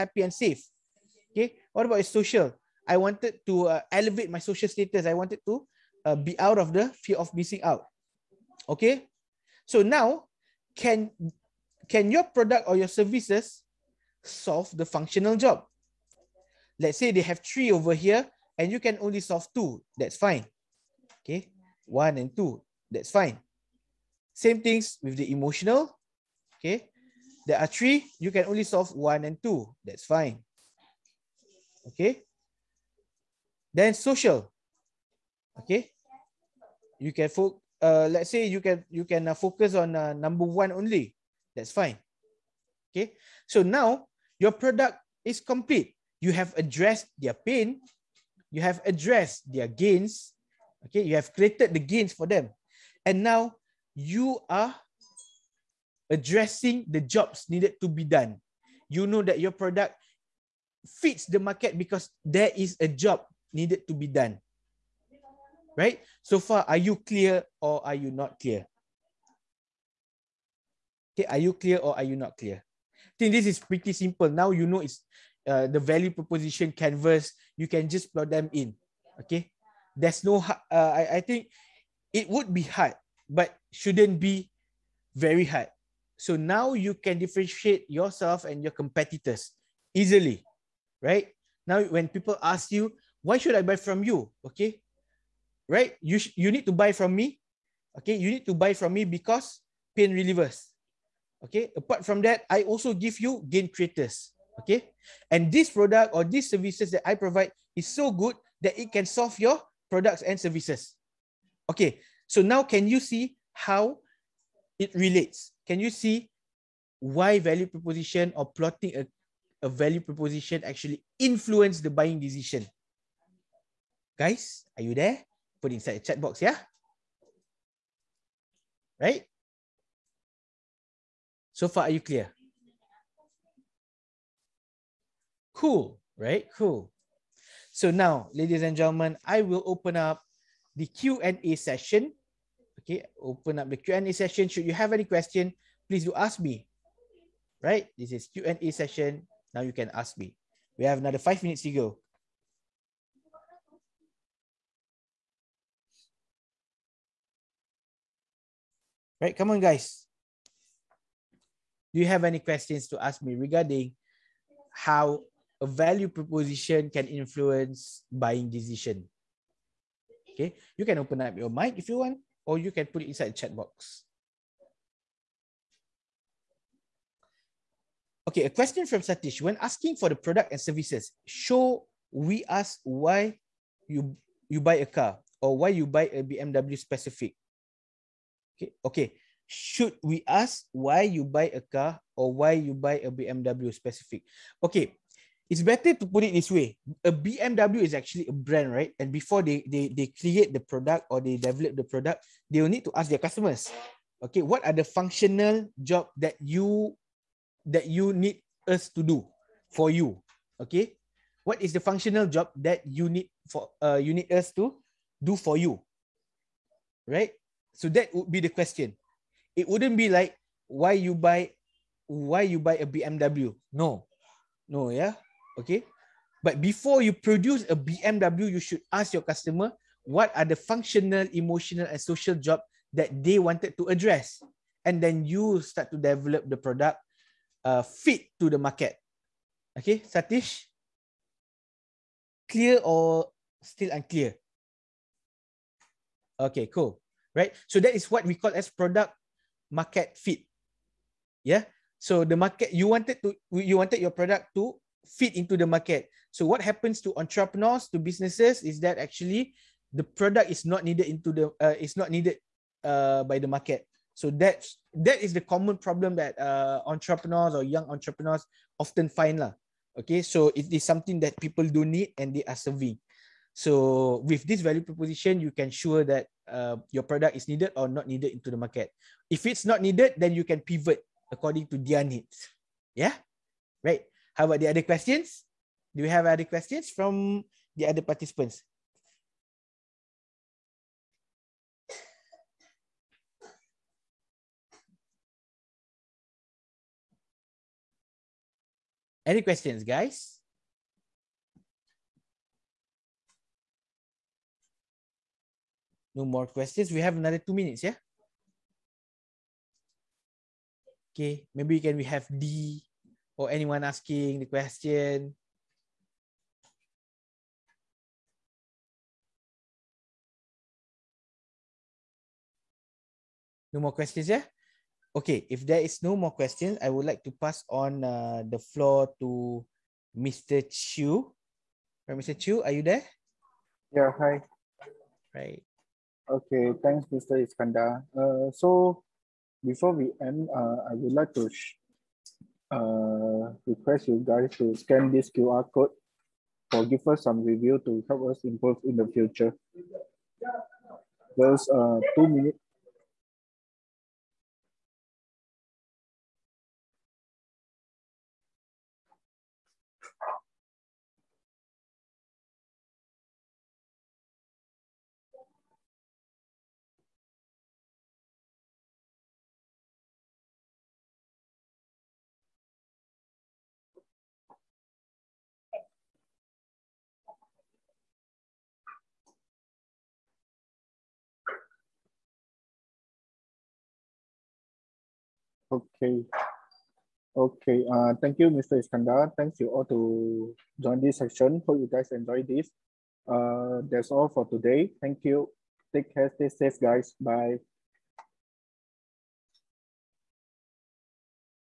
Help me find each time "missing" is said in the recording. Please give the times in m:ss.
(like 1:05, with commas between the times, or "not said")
0:07.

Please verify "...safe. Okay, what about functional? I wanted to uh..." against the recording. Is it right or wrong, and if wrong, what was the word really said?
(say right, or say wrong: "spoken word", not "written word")
wrong: "social", not "functional".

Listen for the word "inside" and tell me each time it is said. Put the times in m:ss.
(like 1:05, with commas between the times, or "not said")
2:05, 2:53.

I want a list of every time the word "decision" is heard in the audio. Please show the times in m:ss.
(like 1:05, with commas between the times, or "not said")
2:02, 2:48.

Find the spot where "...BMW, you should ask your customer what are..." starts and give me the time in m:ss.
3:47.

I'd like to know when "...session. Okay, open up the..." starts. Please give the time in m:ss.
2:21.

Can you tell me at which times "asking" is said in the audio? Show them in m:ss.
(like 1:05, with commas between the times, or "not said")
2:59, 5:13.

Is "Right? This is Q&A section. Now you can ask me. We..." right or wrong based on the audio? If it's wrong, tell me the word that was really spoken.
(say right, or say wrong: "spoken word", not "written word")
wrong: "session", not "section".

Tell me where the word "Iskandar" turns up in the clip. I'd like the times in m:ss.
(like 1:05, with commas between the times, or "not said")
5:37, 6:28.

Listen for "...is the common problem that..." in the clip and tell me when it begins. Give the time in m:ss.
4:25.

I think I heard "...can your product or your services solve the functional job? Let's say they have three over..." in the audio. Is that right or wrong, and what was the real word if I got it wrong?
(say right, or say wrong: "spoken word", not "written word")
right.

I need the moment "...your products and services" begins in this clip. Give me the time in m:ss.
1:49.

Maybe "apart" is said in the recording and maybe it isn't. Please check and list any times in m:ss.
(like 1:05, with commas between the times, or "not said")
1:41.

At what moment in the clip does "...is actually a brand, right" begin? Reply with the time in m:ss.
3:17.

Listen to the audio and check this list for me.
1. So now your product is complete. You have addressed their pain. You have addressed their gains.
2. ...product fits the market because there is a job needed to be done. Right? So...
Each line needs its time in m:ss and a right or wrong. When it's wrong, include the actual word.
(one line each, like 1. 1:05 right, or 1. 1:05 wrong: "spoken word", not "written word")
1. 0:43 right
2. 0:59 right.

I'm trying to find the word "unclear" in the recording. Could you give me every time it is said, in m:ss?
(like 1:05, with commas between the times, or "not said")
4:03.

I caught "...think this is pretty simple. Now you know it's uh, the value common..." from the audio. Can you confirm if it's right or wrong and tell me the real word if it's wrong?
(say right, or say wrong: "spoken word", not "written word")
wrong: "proposition", not "common".